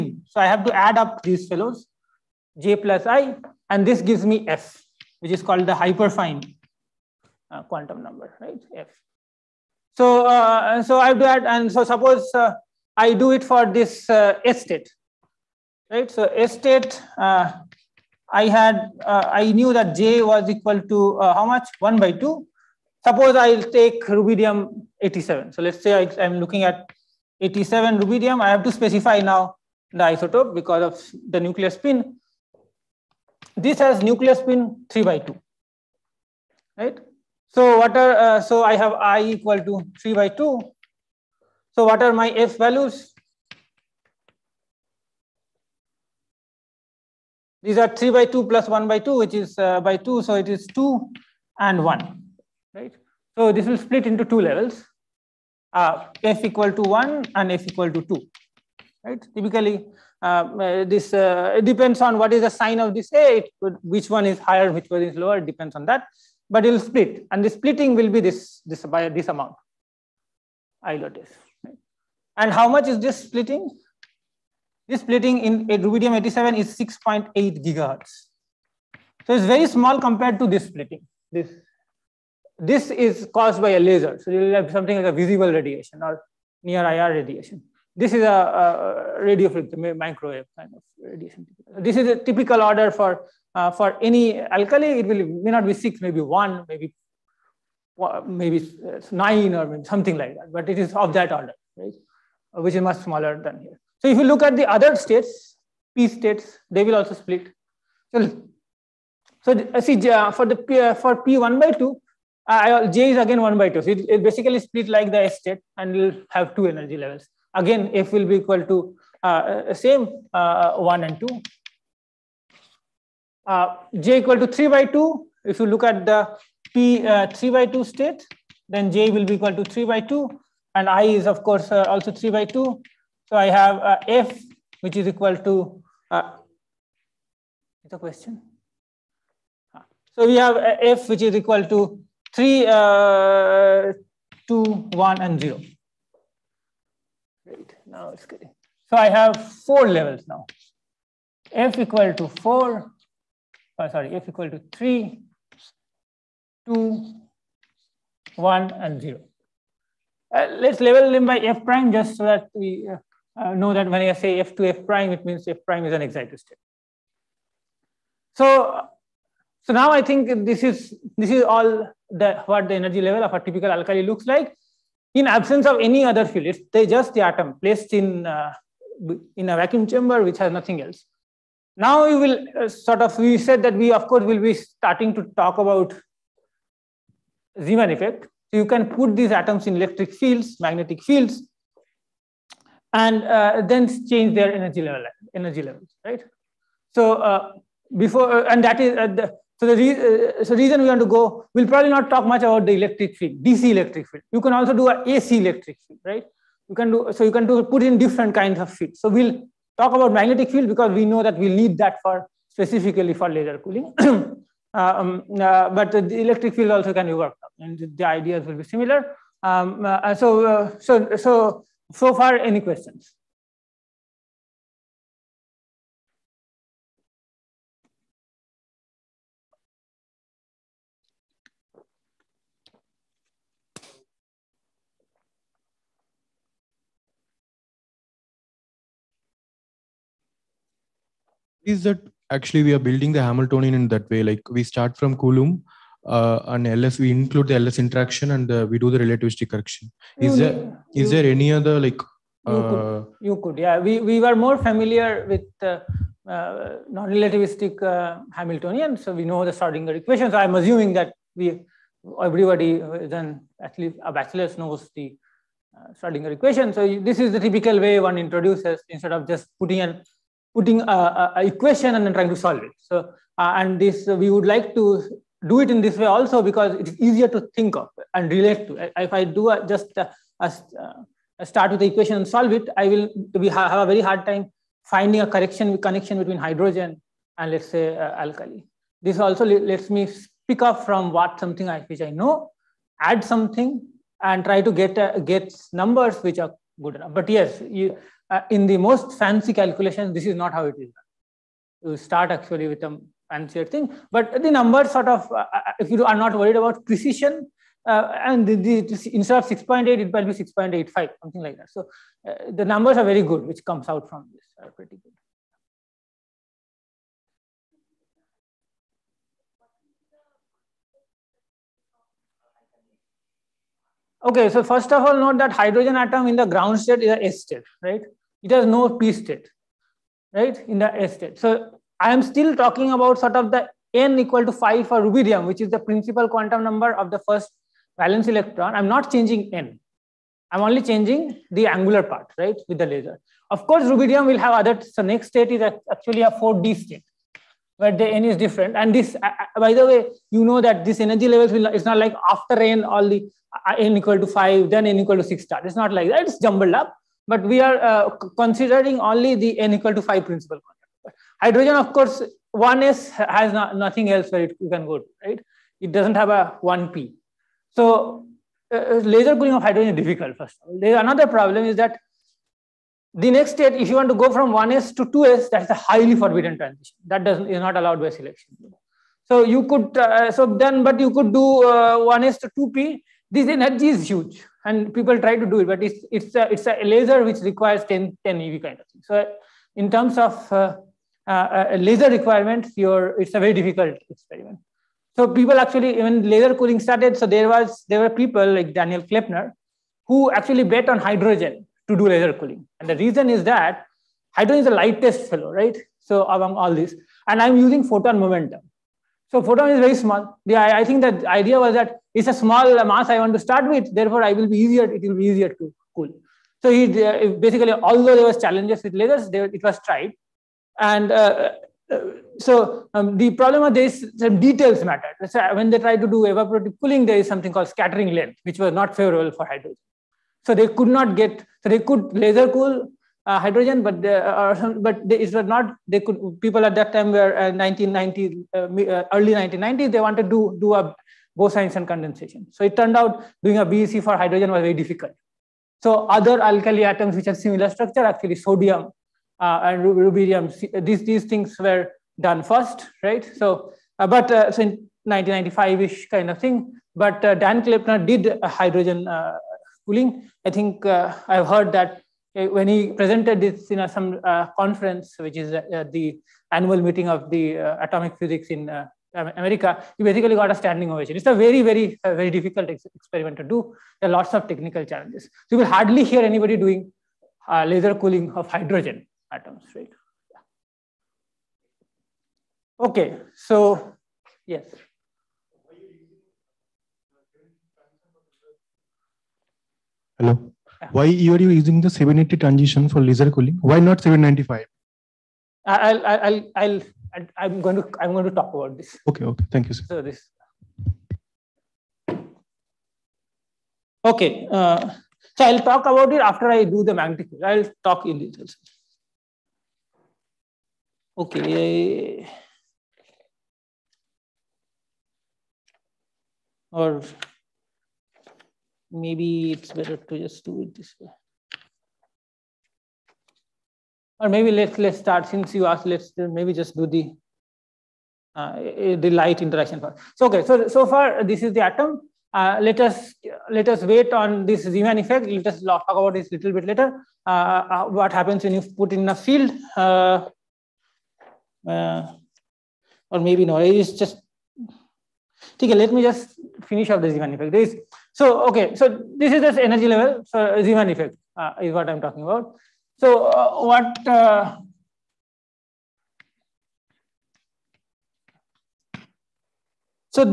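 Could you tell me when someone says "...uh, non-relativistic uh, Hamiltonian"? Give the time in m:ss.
4:16.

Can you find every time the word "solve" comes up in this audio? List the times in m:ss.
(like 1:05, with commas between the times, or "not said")
4:32, 4:42.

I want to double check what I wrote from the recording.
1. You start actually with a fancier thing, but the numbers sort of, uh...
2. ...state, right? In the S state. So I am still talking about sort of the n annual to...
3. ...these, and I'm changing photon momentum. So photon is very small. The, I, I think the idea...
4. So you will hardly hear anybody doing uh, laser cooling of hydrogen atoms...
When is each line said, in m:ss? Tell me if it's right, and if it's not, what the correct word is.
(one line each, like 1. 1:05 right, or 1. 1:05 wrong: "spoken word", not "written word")
1. 5:01 right
2. 5:29 wrong: "equal", not "annual"
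3. 6:46 wrong: "using", not "changing"
4. 7:55 right.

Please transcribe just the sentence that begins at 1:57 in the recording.
Again, f will be equal to uh, uh same uh, uh, 1 and 2.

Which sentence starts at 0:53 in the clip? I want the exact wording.
So this will split into two levels, uh, f equal to one and f equal to two, right?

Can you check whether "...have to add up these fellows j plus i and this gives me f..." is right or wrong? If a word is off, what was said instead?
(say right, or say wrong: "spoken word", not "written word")
right.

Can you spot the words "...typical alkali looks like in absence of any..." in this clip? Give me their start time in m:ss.
2:53.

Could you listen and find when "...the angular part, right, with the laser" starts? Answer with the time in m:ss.
5:41.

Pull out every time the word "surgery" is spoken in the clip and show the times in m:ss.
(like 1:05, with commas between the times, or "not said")
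not said.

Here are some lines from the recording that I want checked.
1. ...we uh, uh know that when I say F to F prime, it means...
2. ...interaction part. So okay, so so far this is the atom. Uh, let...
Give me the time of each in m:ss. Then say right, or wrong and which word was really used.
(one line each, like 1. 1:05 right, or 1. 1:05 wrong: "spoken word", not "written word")
1. 2:42 right
2. 8:49 right.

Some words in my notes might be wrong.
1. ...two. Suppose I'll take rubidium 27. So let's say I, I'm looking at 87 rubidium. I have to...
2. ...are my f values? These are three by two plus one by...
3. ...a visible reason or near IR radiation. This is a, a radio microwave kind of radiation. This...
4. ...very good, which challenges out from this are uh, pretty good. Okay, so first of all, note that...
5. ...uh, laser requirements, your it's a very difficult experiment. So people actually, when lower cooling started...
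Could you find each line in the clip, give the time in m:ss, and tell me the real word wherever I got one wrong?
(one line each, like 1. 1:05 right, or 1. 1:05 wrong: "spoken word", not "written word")
1. 0:22 wrong: "87", not "27"
2. 0:42 right
3. 1:25 wrong: "radiation", not "reason"
4. 5:13 wrong: "comes", not "challenges"
5. 6:31 wrong: "laser", not "lower".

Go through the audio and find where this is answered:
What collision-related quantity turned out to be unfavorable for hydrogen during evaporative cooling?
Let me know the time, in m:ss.
7:07.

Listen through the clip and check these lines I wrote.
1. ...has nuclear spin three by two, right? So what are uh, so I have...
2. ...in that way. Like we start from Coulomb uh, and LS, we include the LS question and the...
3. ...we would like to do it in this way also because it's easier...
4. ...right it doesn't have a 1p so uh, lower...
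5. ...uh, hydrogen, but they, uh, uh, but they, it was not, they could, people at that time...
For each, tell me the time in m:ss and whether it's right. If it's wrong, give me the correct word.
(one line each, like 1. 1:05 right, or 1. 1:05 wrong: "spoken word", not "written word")
1. 0:33 right
2. 4:03 wrong: "interaction", not "question"
3. 4:34 right
4. 6:05 wrong: "laser", not "lower"
5. 7:13 right.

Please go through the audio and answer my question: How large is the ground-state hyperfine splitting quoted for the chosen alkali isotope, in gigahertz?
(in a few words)
6.8 gigahertz.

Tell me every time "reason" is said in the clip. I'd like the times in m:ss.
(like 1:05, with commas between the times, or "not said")
3:20, 6:42.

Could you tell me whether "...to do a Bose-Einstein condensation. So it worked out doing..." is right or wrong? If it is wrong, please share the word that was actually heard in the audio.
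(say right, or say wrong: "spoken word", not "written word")
wrong: "turned", not "worked".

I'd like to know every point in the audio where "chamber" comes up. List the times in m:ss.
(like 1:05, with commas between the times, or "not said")
2:59.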